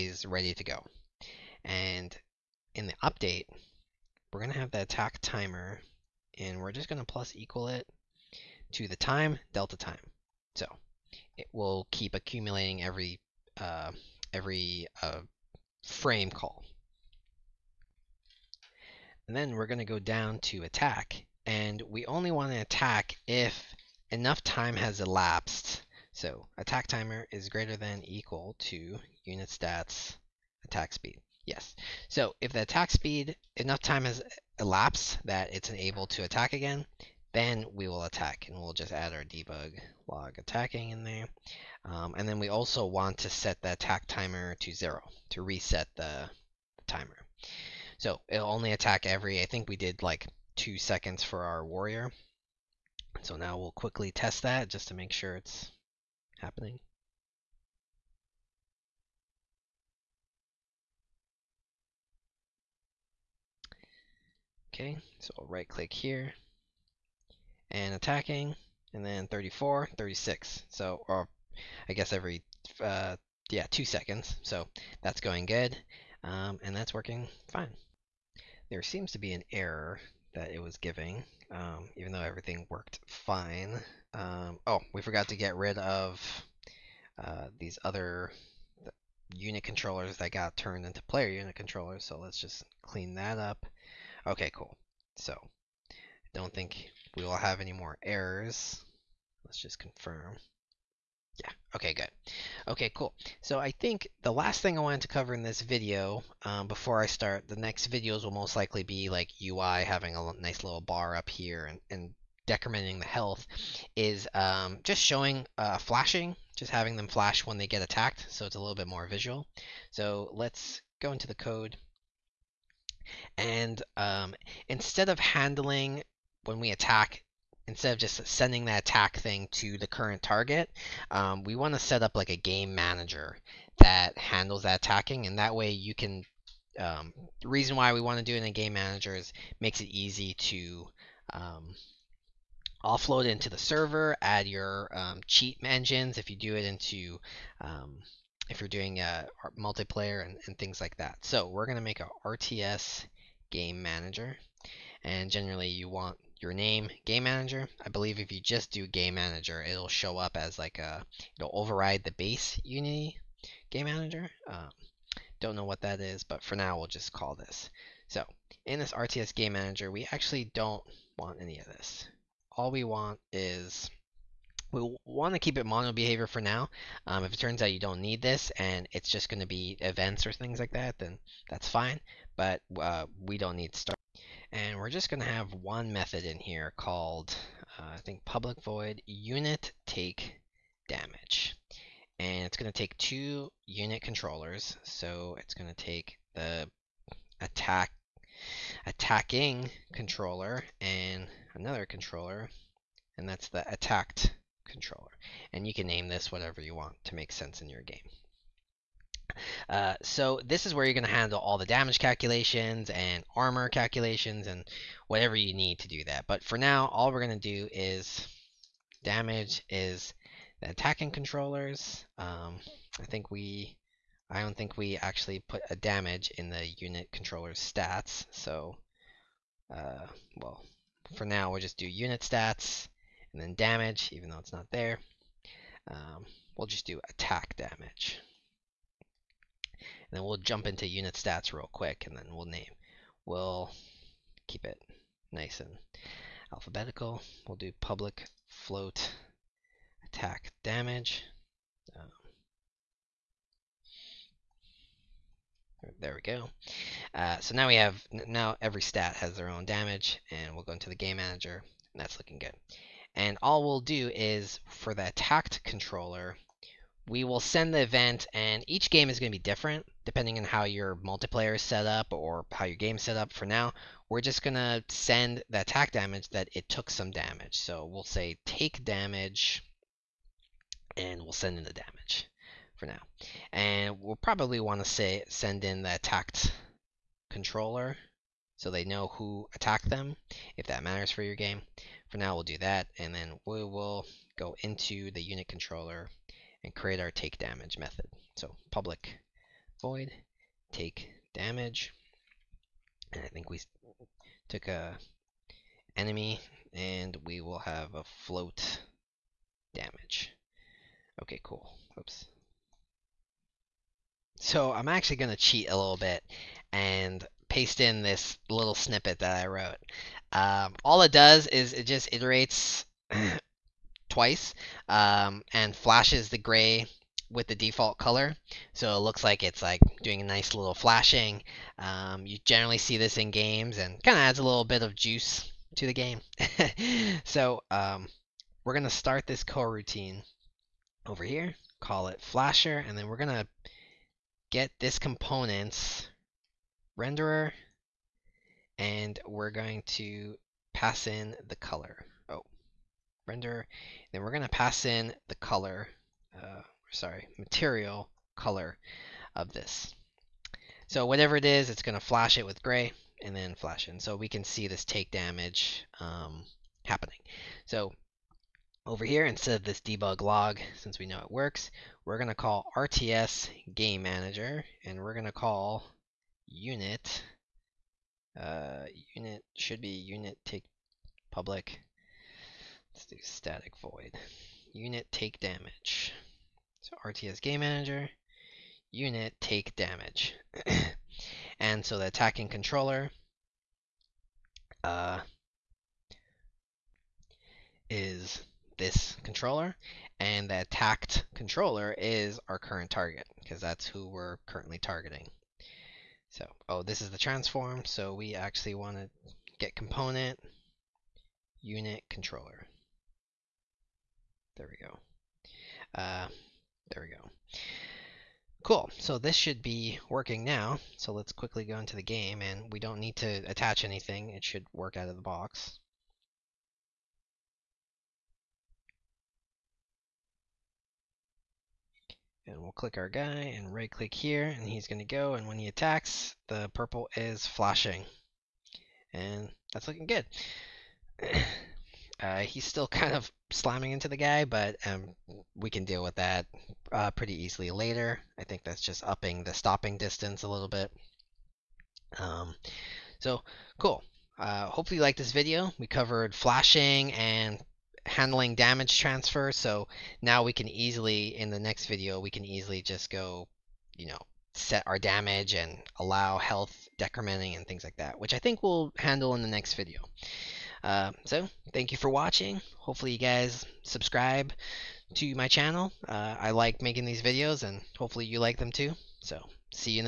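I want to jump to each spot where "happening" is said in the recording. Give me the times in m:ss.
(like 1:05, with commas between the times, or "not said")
0:56, 6:06.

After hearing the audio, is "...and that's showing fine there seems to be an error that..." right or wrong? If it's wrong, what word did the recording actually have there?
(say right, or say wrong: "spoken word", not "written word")
wrong: "working", not "showing".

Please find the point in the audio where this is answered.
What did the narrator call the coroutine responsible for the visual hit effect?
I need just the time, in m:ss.
5:42.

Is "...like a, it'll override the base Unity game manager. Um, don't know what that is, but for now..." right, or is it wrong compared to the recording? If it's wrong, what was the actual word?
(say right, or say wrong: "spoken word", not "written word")
right.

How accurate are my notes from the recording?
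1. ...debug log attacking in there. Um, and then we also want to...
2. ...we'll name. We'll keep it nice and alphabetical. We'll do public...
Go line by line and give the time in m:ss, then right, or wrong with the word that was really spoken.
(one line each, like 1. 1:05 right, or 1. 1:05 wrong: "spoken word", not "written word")
1. 0:39 right
2. 4:02 right.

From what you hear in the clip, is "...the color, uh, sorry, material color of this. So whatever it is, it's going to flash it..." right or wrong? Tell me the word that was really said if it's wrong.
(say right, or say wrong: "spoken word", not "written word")
right.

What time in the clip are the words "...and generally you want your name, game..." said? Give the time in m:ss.
2:35.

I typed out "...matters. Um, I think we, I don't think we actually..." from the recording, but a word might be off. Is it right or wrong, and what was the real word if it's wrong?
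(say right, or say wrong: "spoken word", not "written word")
wrong: "controllers", not "matters".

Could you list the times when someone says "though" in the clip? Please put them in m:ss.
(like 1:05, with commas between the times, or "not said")
1:22, 3:54.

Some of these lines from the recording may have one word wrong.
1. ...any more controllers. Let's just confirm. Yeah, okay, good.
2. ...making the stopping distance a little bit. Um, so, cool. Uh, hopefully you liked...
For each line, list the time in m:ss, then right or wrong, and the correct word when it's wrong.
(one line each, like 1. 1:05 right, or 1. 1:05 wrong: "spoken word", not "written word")
1. 1:37 wrong: "errors", not "controllers"
2. 7:29 wrong: "upping", not "making".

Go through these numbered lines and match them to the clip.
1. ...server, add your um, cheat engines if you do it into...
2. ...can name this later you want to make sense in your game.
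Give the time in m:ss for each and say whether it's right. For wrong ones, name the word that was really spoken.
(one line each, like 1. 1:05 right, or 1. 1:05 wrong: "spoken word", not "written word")
1. 2:23 right
2. 3:25 wrong: "whatever", not "later".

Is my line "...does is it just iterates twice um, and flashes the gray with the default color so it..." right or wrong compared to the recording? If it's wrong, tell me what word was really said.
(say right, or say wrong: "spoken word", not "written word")
right.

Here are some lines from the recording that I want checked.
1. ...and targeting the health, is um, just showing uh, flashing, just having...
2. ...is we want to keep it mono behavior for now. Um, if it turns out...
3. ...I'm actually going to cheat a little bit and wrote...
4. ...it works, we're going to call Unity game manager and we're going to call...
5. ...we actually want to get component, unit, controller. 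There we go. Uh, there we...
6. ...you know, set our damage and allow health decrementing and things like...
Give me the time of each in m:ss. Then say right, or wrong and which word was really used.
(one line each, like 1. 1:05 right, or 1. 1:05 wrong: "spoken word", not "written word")
1. 1:51 wrong: "decrementing", not "targeting"
2. 2:53 right
3. 5:14 wrong: "paste", not "wrote"
4. 6:11 wrong: "RTS", not "Unity"
5. 6:48 right
6. 7:43 right.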